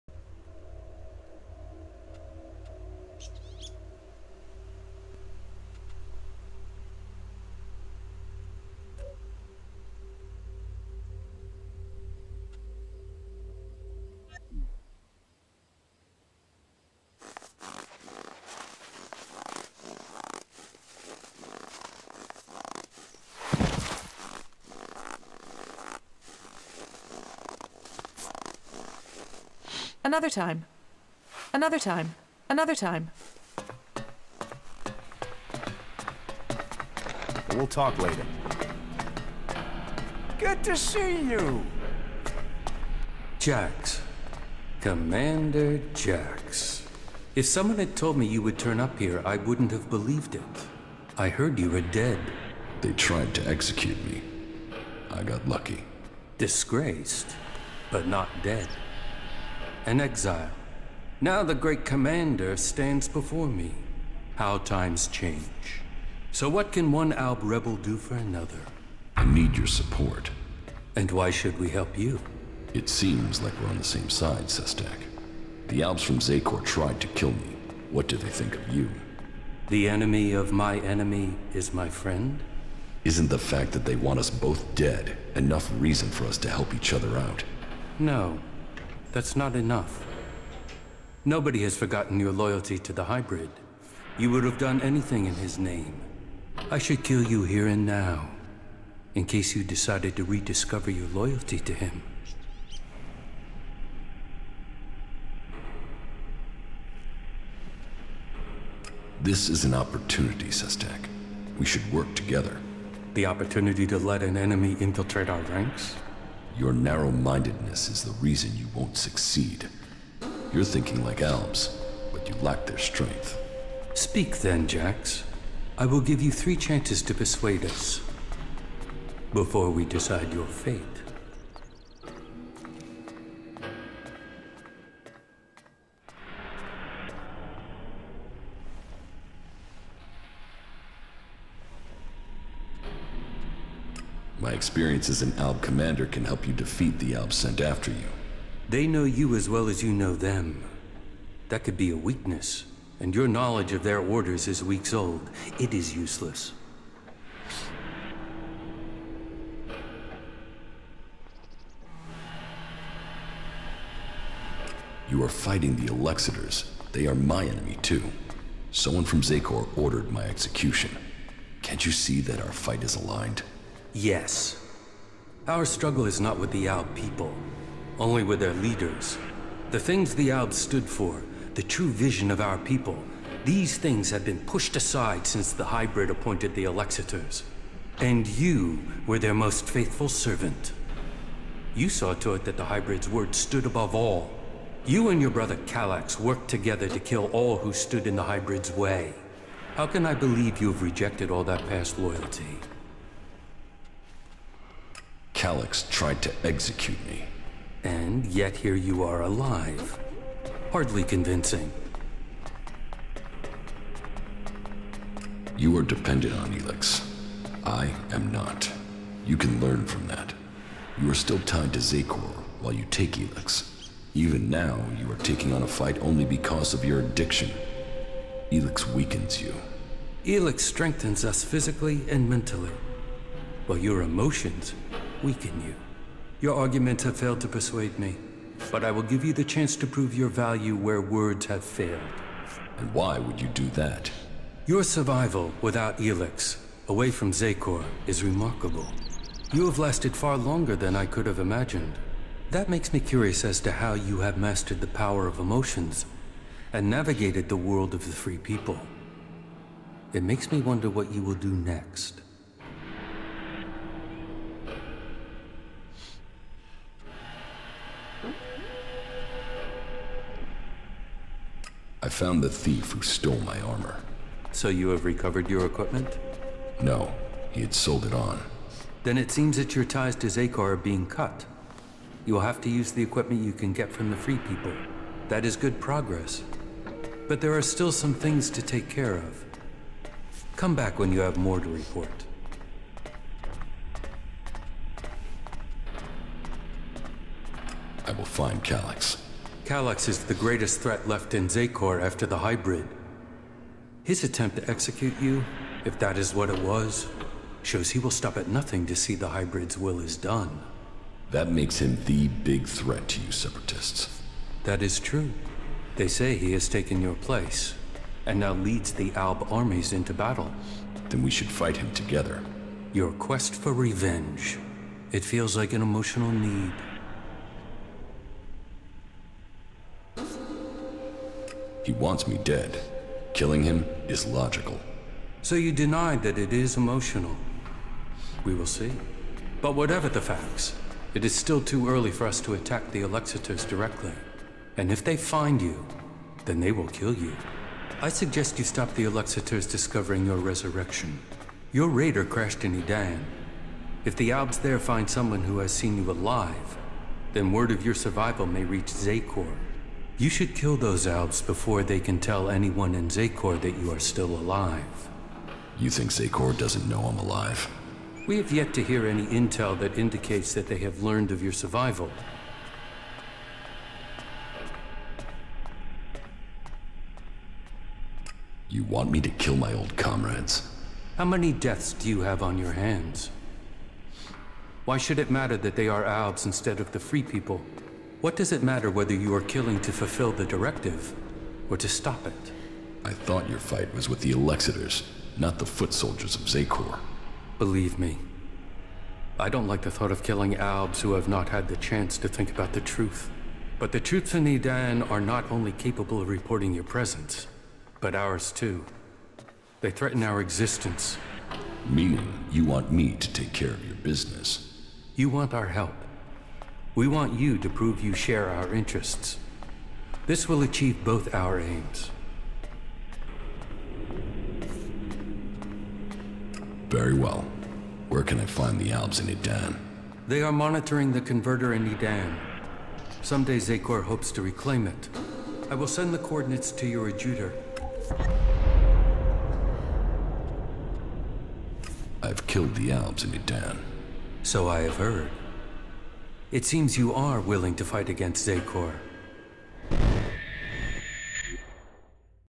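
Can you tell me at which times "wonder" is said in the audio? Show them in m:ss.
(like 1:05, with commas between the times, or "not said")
4:20.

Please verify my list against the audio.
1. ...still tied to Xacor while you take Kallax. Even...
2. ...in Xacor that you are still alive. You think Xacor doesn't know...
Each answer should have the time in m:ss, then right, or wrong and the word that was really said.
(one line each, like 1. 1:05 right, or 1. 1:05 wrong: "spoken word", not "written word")
1. 3:41 wrong: "Elex", not "Kallax"
2. 6:02 right.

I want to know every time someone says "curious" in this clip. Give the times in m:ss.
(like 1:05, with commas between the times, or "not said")
4:12.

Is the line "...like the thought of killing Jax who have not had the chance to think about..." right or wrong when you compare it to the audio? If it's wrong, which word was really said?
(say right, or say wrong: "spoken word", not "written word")
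wrong: "Albs", not "Jax".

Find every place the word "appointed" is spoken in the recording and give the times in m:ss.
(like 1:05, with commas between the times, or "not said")
3:06.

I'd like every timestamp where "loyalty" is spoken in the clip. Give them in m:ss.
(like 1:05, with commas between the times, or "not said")
1:32, 1:41, 3:21.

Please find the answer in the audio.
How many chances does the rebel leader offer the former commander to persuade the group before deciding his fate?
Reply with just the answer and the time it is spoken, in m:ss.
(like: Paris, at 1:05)
3, at 2:06.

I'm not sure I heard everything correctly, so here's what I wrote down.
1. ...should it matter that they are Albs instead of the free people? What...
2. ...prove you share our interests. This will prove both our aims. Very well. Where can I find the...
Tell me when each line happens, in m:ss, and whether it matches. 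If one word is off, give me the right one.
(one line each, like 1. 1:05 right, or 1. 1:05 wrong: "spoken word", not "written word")
1. 6:24 right
2. 6:57 wrong: "achieve", not "prove".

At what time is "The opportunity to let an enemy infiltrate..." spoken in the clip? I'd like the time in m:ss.
1:53.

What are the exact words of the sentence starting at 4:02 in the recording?
And why would you do that?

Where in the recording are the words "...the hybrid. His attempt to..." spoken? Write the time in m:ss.
5:02.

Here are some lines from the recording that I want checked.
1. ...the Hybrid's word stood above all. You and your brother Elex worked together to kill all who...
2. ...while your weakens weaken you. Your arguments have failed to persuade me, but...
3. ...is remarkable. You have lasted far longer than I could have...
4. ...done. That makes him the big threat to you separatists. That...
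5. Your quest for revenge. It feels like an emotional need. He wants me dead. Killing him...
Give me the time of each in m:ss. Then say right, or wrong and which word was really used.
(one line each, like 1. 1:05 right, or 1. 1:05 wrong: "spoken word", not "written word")
1. 3:12 wrong: "Kallax", not "Elex"
2. 3:53 wrong: "emotions", not "weakens"
3. 4:08 right
4. 5:10 right
5. 5:22 right.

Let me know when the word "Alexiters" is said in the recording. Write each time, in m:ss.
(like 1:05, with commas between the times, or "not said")
2:45, 3:06, 5:43, 5:49, 6:34.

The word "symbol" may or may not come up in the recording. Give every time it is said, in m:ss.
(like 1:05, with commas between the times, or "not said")
not said.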